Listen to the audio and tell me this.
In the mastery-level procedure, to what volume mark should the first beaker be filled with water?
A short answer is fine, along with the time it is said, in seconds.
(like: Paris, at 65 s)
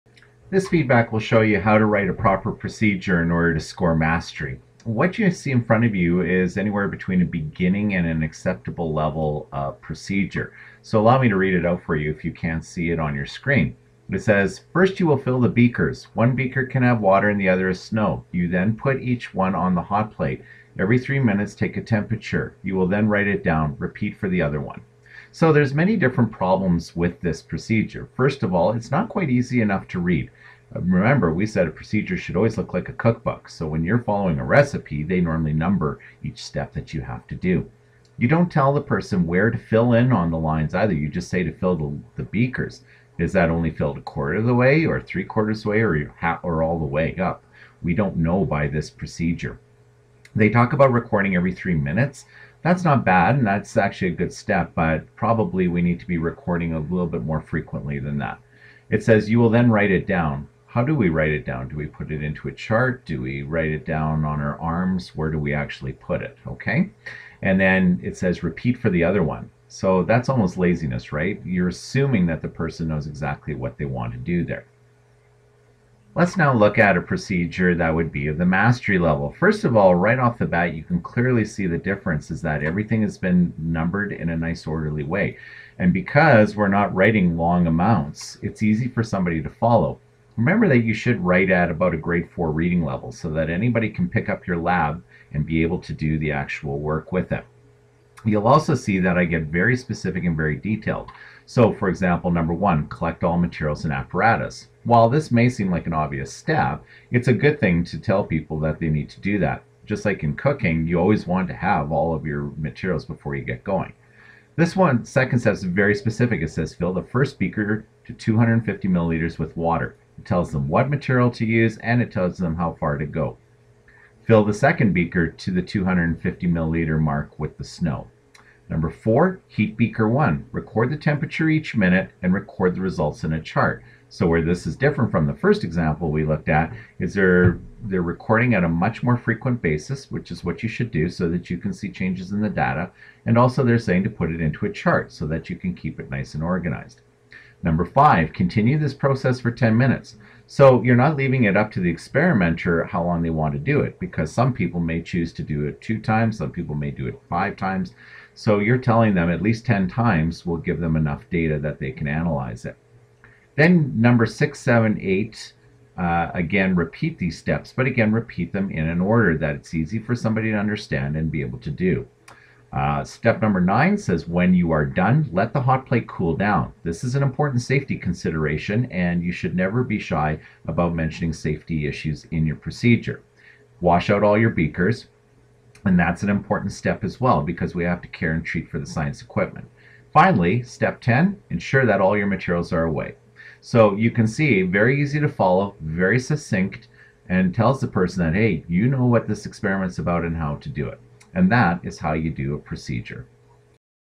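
250 milliliters, at 118 s.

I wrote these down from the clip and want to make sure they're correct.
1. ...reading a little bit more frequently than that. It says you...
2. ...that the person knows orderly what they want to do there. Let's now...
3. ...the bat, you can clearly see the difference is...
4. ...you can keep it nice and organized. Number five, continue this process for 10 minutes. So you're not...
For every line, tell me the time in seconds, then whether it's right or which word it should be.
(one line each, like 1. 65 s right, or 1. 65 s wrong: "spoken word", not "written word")
1. 56 s wrong: "recording", not "reading"
2. 72 s wrong: "exactly", not "orderly"
3. 80 s right
4. 145 s right.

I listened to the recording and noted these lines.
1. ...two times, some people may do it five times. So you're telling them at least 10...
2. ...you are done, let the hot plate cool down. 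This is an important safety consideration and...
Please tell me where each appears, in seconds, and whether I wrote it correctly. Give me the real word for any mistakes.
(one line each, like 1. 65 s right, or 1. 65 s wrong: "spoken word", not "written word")
1. 155 s right
2. 174 s right.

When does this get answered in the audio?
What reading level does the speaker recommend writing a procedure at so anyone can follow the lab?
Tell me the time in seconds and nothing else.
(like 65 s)
91 s.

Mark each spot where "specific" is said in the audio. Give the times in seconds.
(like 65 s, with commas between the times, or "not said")
99 s, 115 s.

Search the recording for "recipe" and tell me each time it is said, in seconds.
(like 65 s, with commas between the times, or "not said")
34 s.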